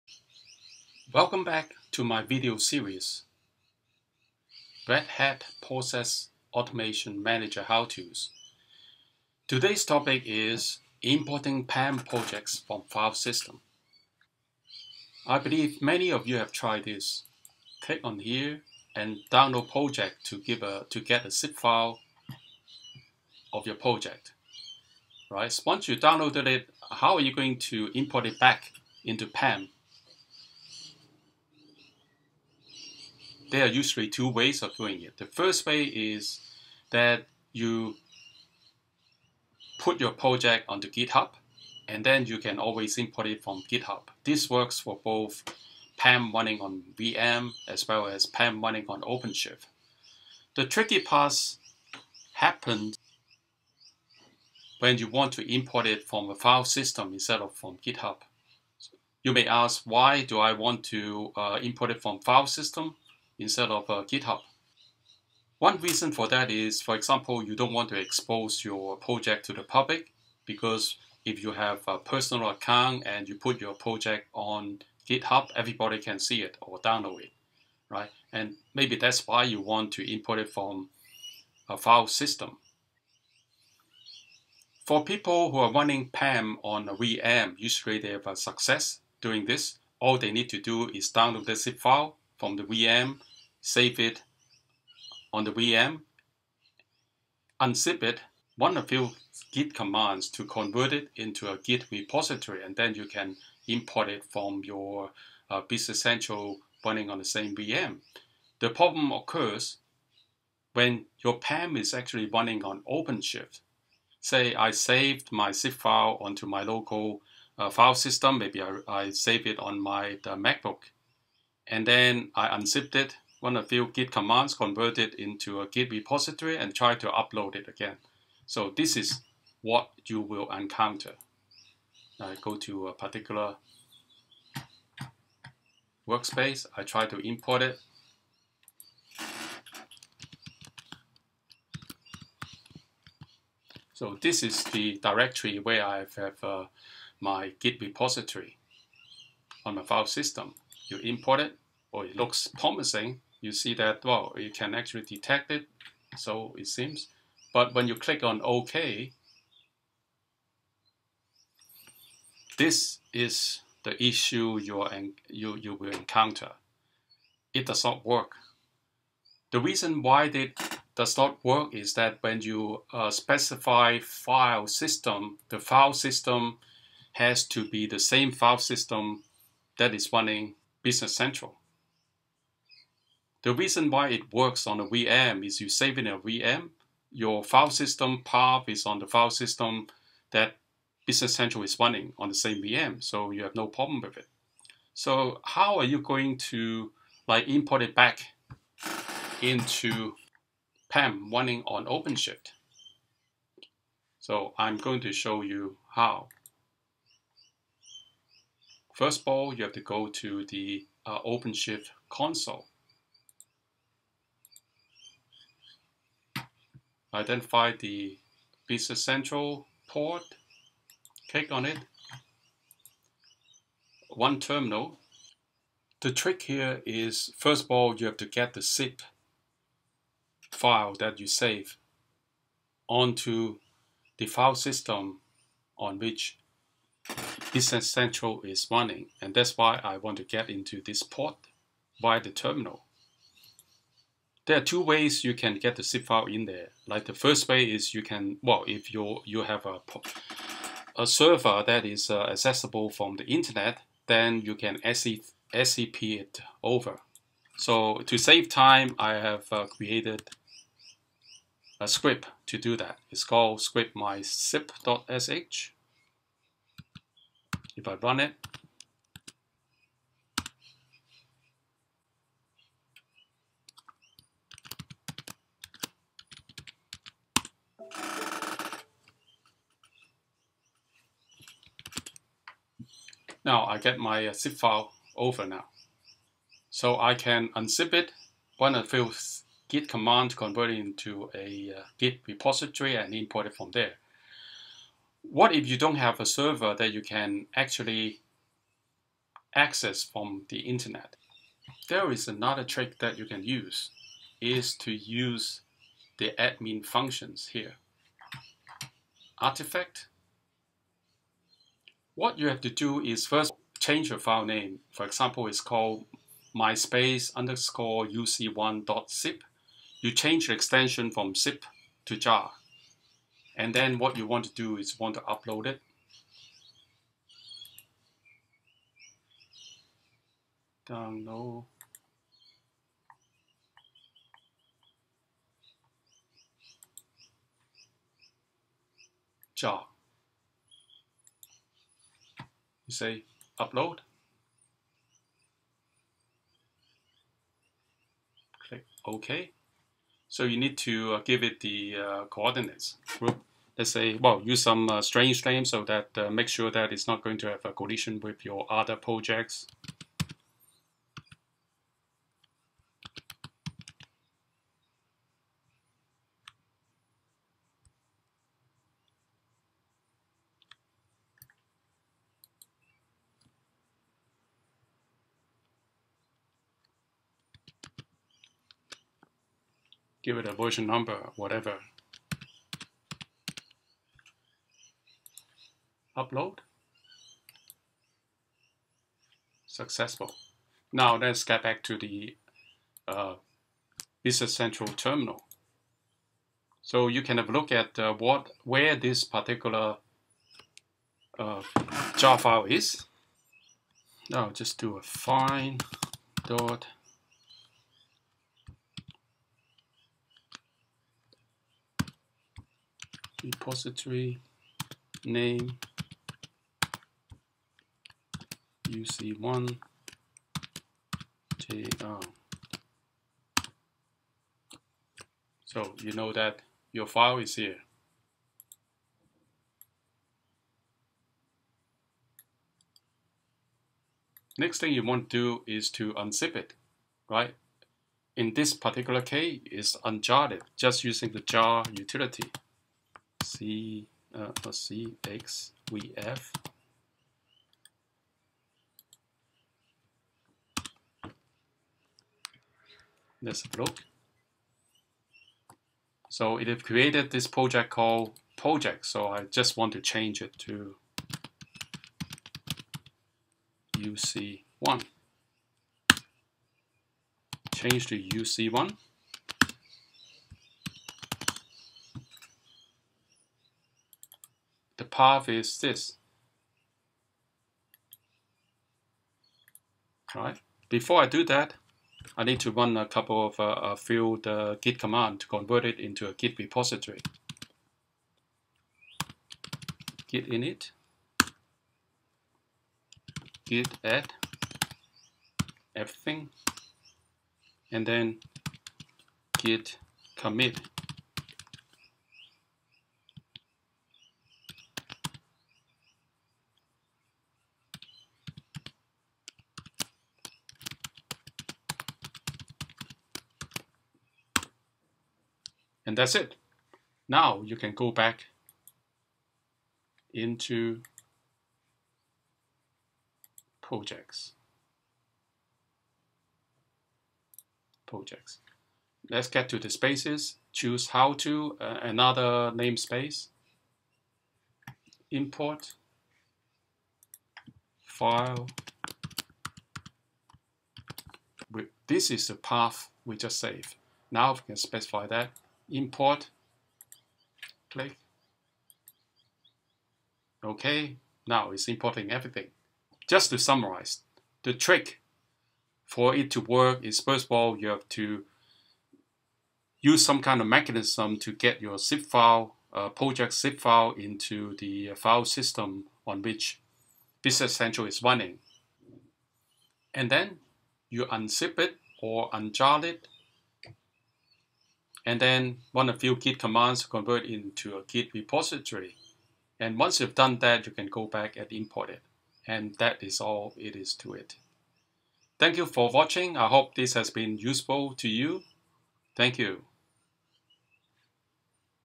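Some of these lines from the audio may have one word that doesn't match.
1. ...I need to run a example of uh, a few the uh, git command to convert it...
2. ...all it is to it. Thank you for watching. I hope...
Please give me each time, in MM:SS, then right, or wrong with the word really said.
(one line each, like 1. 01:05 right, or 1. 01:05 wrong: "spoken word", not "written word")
1. 08:02 wrong: "couple", not "example"
2. 09:43 right.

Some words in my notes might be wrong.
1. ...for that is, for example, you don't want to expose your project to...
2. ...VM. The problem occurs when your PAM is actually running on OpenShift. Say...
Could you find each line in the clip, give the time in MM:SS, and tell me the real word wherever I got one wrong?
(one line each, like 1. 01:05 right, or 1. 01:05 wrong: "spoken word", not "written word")
1. 01:06 right
2. 01:47 right.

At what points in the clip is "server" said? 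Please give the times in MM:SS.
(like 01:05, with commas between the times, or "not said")
04:11, 04:56.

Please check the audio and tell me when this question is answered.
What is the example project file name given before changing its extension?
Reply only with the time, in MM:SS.
05:16.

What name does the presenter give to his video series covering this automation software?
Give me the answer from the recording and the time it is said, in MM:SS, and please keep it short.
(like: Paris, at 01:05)
Red Hat Process Automation Manager How-Tos, at 00:04.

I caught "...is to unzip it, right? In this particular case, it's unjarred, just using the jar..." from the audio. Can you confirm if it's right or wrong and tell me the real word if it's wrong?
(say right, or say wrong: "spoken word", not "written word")
right.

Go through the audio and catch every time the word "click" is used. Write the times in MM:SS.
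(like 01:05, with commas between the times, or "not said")
00:17, 02:37, 03:41, 05:48, 09:07.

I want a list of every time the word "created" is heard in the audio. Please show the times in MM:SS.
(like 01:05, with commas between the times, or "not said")
04:19, 07:36.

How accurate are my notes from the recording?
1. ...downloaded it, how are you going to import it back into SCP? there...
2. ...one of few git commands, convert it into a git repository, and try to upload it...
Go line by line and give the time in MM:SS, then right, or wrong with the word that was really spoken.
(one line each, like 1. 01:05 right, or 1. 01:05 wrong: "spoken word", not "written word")
1. 00:25 wrong: "PAM", not "SCP"
2. 02:03 right.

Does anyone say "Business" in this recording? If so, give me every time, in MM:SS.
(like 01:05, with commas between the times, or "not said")
01:45, 03:00, 03:11, 03:38, 03:57, 06:34, 09:27.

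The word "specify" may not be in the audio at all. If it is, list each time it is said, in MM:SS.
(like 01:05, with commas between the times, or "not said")
02:53, 09:04.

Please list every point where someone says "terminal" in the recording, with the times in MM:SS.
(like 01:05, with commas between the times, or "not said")
03:44, 04:02, 06:34.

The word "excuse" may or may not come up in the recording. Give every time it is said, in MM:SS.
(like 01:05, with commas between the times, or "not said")
not said.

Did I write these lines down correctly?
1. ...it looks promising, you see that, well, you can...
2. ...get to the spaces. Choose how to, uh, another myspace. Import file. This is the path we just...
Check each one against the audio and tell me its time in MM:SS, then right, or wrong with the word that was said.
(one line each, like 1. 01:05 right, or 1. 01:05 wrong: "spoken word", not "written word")
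1. 02:32 right
2. 08:49 wrong: "namespace", not "myspace".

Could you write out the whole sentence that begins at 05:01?
There is another trick that you can use is to use the admin functions here.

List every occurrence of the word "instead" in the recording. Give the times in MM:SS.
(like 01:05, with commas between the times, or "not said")
00:57, 01:03.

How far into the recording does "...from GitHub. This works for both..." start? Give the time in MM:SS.
00:43.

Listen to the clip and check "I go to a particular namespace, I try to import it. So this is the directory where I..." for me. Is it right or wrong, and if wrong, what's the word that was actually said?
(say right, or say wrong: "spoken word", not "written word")
wrong: "workspace", not "namespace".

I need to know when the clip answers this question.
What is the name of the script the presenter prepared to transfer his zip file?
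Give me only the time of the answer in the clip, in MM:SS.
04:23.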